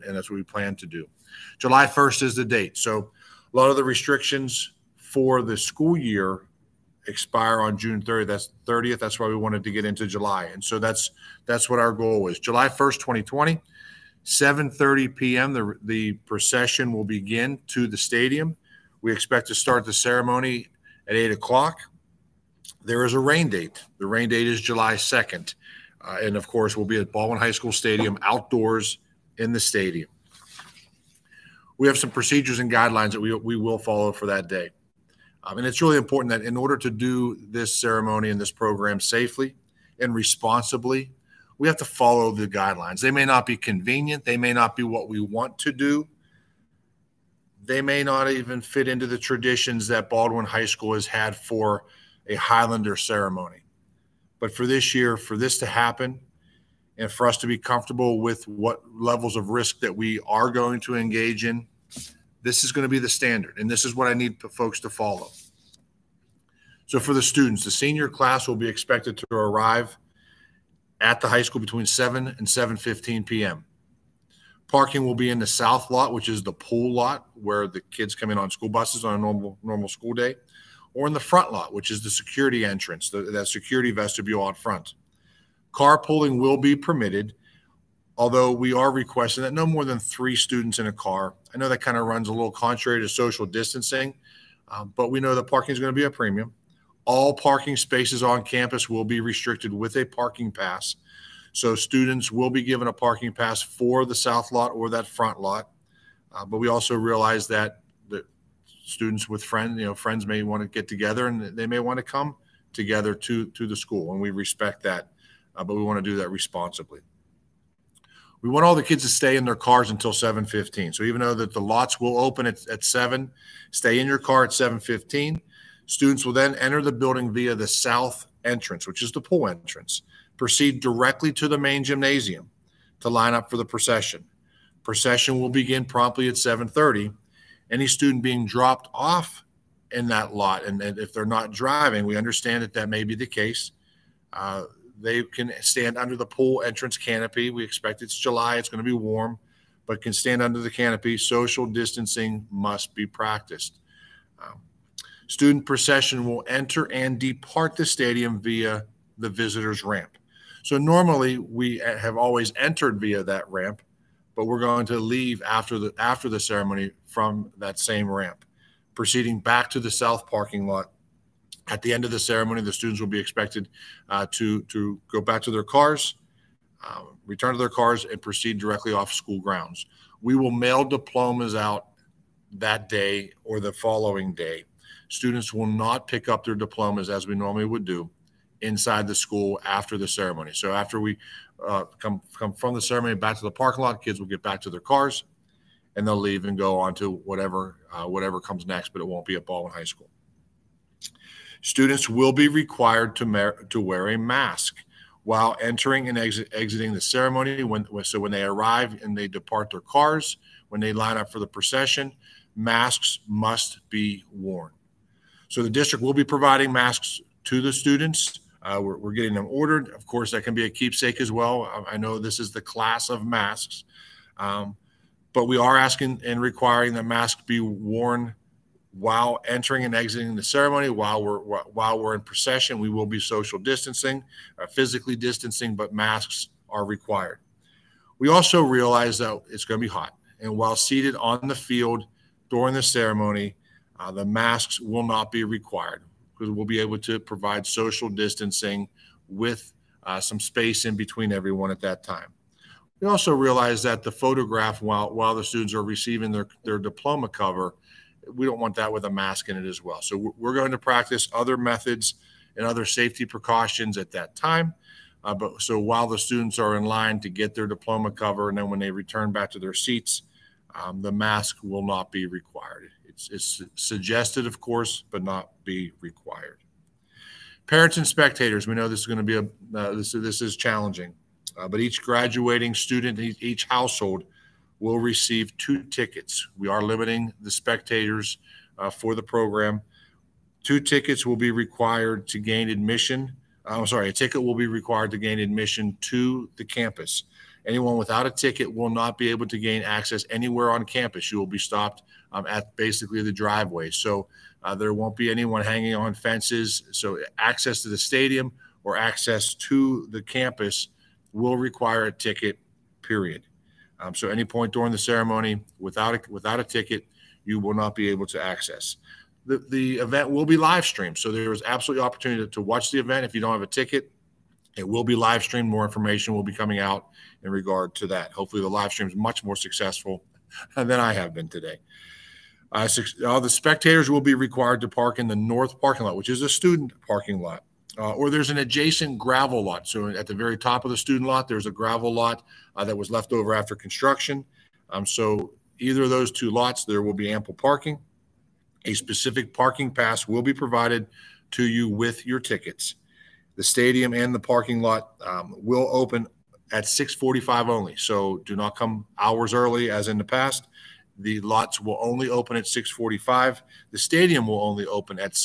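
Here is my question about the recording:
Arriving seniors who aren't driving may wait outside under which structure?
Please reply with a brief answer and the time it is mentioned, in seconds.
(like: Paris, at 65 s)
Pool entrance canopy, at 146 s.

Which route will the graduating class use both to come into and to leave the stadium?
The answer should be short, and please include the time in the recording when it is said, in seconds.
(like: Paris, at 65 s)
Visitors' ramp, at 159 s.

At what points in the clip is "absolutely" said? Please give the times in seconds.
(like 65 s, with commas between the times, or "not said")
321 s.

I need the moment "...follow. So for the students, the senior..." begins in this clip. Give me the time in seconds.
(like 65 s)
64 s.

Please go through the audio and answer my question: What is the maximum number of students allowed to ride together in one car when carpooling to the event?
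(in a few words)
3.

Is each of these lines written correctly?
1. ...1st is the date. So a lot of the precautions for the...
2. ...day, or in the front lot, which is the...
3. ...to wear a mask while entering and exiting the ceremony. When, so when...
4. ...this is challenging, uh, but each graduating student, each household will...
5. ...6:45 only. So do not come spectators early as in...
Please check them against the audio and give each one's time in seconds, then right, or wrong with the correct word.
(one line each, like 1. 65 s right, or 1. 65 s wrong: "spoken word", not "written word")
1. 1 s wrong: "restrictions", not "precautions"
2. 80 s right
3. 203 s right
4. 280 s right
5. 356 s wrong: "hours", not "spectators".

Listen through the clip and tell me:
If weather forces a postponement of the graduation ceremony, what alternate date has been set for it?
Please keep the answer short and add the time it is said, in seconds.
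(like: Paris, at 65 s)
July 2, at 24 s.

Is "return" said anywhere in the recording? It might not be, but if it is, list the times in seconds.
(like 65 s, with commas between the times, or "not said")
177 s, 268 s.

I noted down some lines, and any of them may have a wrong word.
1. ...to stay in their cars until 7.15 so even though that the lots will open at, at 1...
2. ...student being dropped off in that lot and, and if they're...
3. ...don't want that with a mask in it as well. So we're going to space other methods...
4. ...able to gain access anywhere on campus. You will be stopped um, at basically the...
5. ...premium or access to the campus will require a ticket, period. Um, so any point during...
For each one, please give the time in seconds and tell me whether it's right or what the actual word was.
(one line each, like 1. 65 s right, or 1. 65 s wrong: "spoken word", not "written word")
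1. 119 s wrong: "7", not "1"
2. 137 s right
3. 258 s wrong: "practice", not "space"
4. 299 s right
5. 307 s wrong: "stadium", not "premium".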